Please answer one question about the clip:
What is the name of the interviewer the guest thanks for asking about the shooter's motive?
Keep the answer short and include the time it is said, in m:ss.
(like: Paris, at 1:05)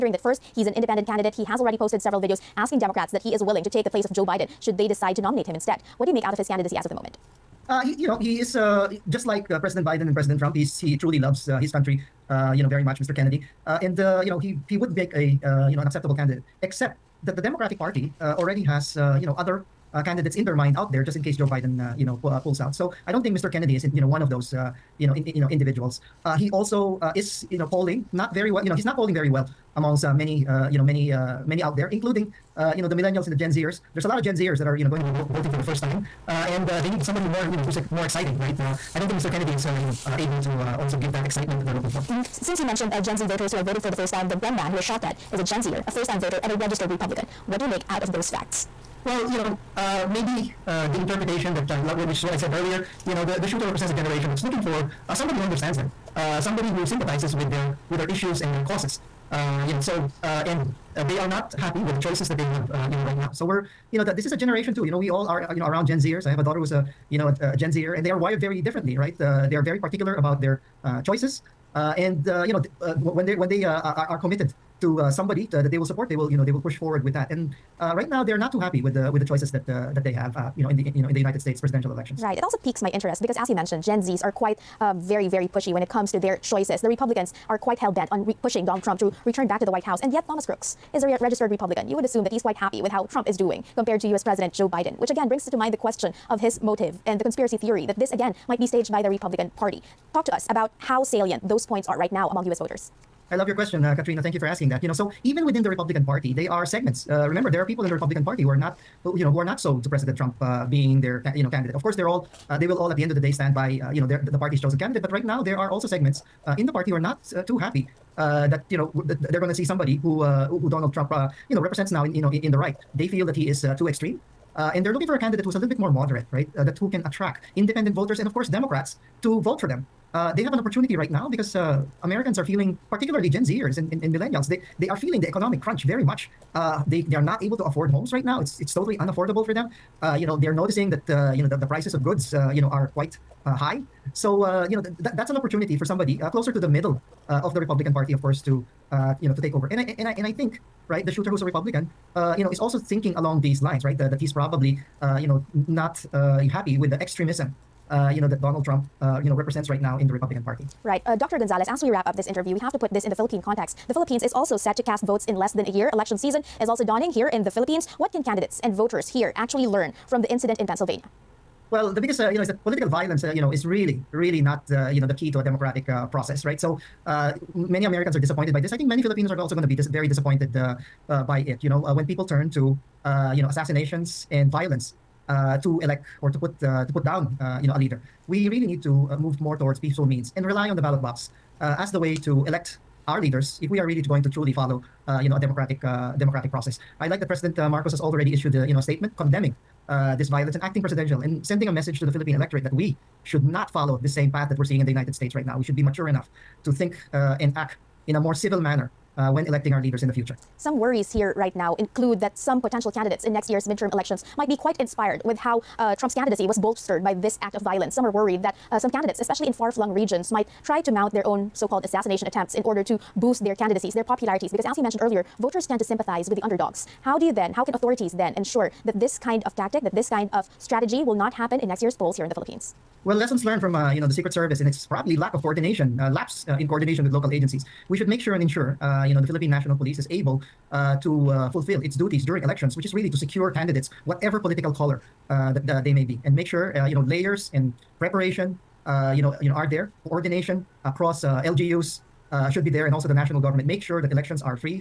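Katrina, at 1:43.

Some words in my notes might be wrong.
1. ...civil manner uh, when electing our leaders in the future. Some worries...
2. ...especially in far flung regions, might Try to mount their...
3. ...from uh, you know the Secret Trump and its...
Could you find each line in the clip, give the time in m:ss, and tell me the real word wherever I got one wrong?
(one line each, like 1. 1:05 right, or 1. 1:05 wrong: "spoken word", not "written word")
1. 3:28 right
2. 3:39 right
3. 3:53 wrong: "Service", not "Trump".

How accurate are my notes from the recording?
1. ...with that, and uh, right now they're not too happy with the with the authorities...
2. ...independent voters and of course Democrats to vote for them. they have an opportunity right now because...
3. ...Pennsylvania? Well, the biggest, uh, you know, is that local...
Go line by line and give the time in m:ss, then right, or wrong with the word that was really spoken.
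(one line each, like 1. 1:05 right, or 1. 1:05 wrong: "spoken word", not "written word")
1. 1:17 wrong: "choices", not "authorities"
2. 2:07 right
3. 2:50 wrong: "political", not "local".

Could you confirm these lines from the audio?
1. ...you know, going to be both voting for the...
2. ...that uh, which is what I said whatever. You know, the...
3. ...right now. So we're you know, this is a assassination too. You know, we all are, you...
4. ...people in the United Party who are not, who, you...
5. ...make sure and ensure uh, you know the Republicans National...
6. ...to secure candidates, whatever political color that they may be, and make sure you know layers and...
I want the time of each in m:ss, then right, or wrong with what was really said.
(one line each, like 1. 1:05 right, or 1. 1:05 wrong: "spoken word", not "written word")
1. 0:34 right
2. 0:51 wrong: "earlier", not "whatever"
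3. 1:03 wrong: "generation", not "assassination"
4. 1:47 wrong: "Republican", not "United"
5. 3:58 wrong: "Philippine", not "Republicans"
6. 4:03 right.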